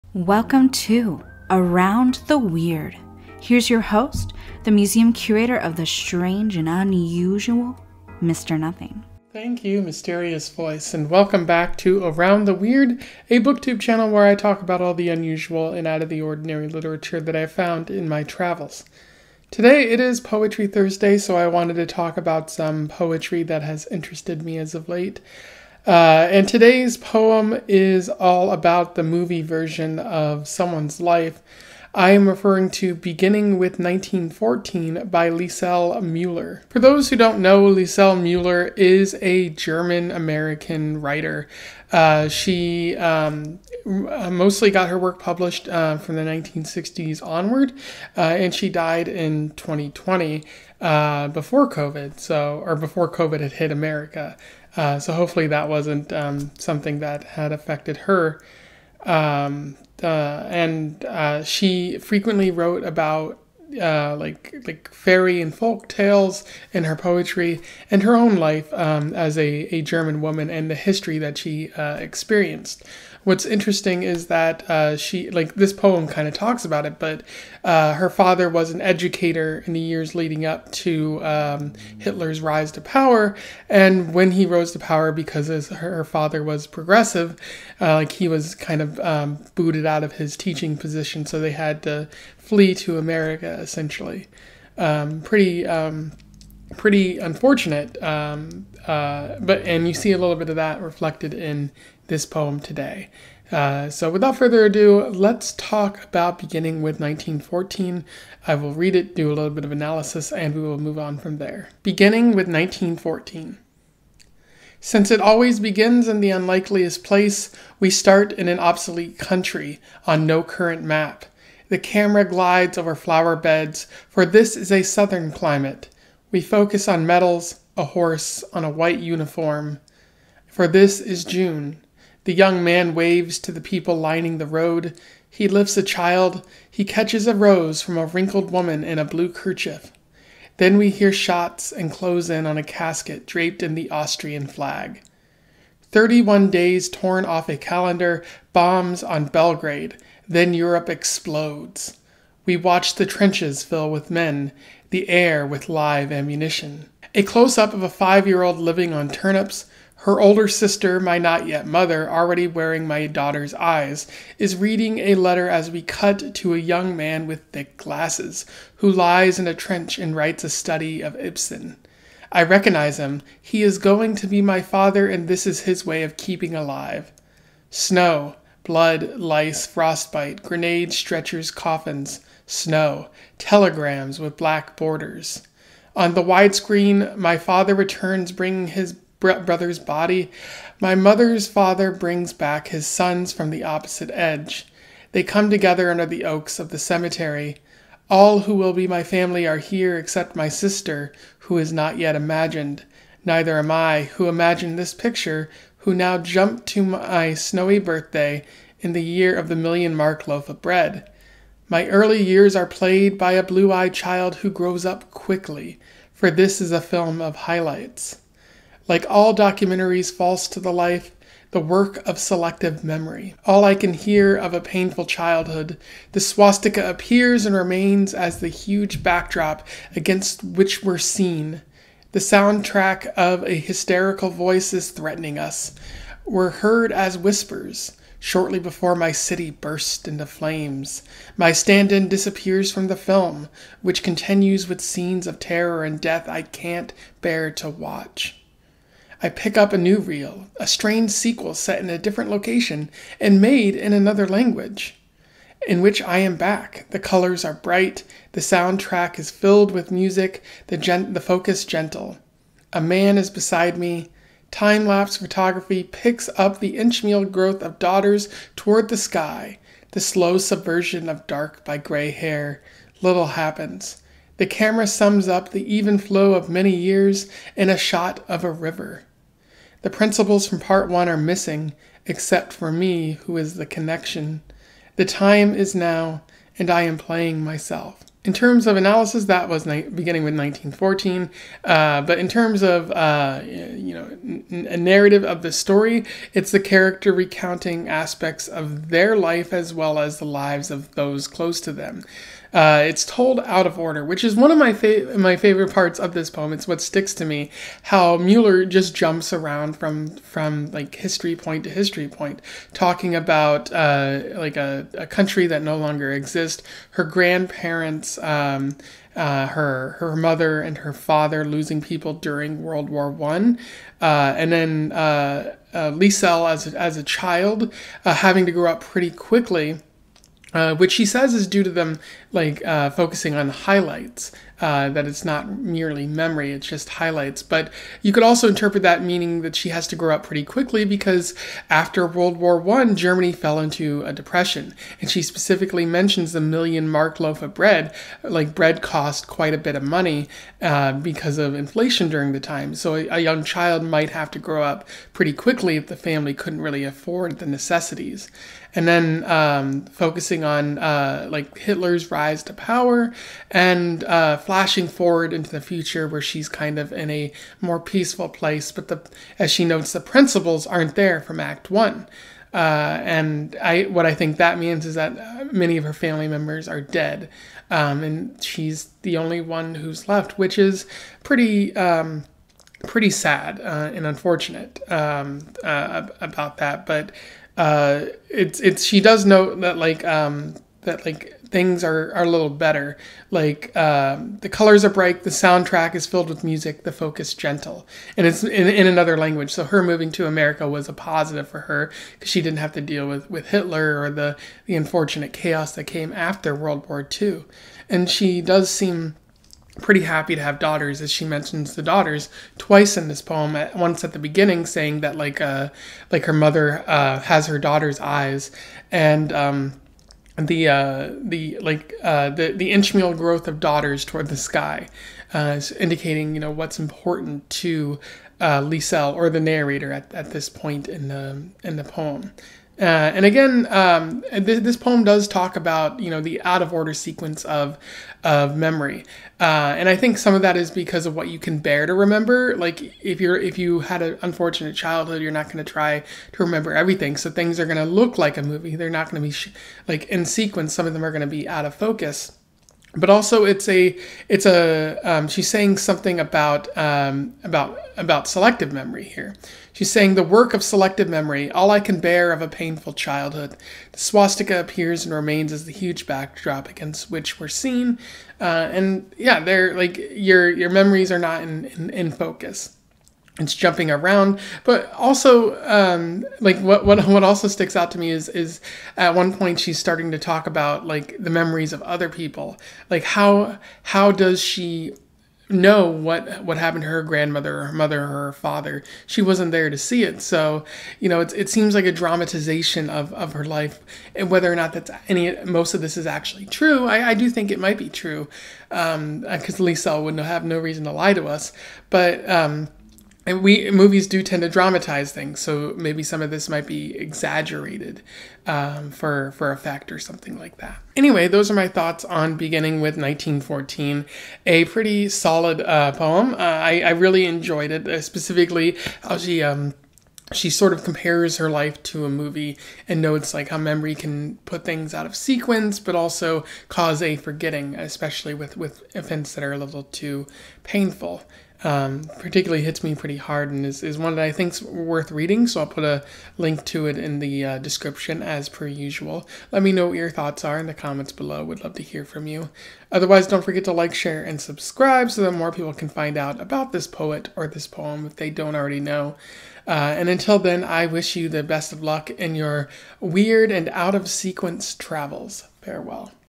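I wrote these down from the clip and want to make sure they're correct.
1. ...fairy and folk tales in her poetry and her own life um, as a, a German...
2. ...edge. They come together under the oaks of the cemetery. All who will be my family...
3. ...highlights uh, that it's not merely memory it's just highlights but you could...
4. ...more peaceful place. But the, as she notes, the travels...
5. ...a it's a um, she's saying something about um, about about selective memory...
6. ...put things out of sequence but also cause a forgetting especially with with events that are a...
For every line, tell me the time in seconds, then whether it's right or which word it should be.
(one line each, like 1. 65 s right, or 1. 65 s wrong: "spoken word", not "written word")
1. 64 s right
2. 194 s right
3. 333 s right
4. 367 s wrong: "principals", not "travels"
5. 453 s right
6. 524 s right.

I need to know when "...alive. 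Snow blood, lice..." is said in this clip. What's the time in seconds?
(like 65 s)
176 s.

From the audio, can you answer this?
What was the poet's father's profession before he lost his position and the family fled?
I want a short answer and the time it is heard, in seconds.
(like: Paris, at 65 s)
educator, at 78 s.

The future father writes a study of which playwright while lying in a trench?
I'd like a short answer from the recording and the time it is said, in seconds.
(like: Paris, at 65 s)
Ibsen, at 171 s.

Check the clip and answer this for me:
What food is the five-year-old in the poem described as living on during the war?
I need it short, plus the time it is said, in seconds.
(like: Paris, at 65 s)
turnips, at 159 s.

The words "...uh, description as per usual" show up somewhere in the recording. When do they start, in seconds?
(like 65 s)
537 s.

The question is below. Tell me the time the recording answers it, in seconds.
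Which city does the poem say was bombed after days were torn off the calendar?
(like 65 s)
149 s.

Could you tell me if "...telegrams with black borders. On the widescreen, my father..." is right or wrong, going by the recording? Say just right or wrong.
right.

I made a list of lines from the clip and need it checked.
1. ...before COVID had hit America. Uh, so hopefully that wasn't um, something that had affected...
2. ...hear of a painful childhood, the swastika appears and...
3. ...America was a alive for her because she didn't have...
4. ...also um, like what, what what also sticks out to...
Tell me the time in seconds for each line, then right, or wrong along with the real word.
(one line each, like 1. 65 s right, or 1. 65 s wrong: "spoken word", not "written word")
1. 52 s right
2. 223 s right
3. 400 s wrong: "positive", not "alive"
4. 474 s right.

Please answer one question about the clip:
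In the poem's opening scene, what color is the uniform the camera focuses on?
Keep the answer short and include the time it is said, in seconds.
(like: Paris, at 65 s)
white, at 128 s.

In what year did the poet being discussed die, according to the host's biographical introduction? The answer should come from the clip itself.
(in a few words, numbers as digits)
2020.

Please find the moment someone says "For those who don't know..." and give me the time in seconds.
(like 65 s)
36 s.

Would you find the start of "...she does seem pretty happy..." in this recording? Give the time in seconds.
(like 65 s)
408 s.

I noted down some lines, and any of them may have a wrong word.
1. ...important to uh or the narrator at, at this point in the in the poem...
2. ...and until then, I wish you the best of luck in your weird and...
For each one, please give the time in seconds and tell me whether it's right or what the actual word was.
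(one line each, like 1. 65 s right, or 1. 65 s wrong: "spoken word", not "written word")
1. 426 s right
2. 549 s right.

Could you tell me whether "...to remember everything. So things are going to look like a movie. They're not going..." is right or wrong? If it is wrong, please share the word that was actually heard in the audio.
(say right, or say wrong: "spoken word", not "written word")
right.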